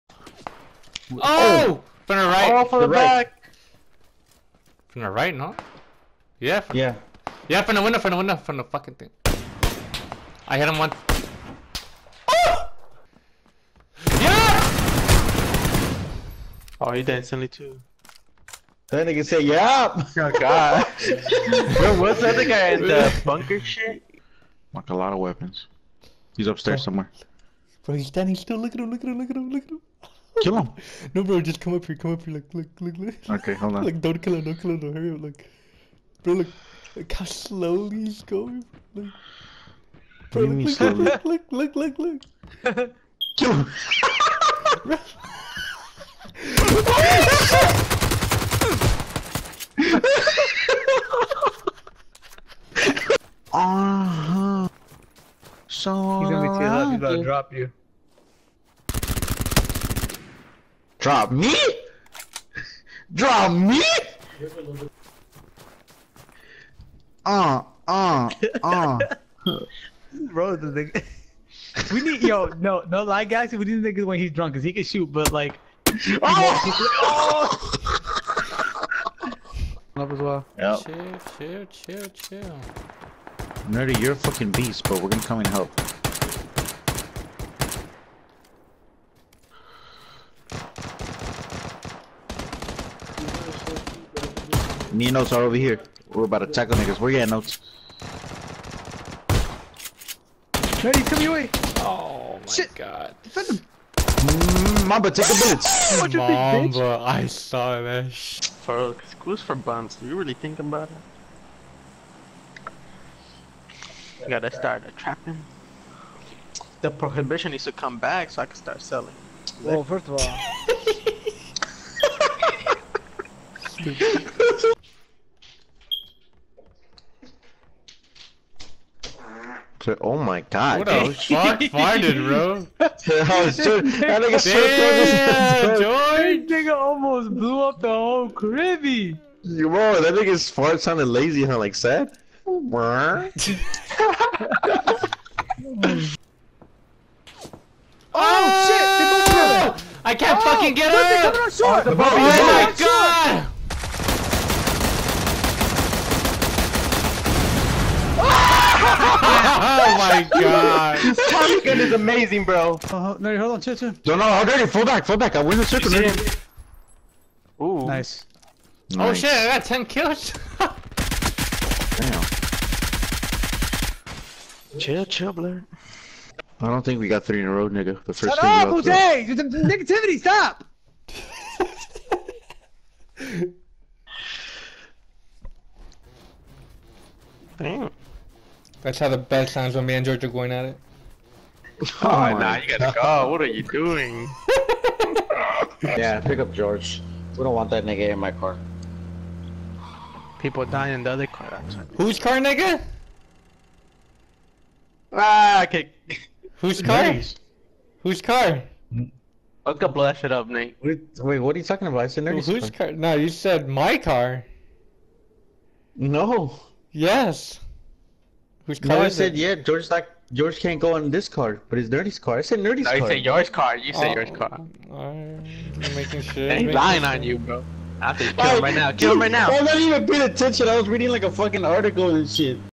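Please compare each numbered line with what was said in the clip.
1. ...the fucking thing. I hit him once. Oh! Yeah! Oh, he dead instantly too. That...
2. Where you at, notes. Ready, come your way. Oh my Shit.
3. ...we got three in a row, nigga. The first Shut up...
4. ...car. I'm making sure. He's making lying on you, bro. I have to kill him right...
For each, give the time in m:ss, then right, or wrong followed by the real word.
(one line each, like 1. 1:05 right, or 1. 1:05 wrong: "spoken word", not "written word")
1. 0:08 right
2. 1:36 right
3. 2:56 right
4. 3:44 right.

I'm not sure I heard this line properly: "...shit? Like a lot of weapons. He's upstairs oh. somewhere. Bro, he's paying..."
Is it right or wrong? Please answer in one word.
wrong.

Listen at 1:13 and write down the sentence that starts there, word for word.
We need niggas when he's drunk, cause he can shoot, but like.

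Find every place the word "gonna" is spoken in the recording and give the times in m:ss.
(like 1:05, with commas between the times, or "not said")
0:56, 1:25.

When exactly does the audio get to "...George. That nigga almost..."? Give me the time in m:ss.
2:15.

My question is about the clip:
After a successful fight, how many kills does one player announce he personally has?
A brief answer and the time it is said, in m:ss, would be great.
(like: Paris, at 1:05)
10, at 2:49.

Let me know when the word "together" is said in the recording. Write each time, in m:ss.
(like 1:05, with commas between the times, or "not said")
2:29.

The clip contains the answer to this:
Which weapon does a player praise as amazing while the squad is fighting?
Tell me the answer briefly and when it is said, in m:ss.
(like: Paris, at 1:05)
Tommy gun, at 2:41.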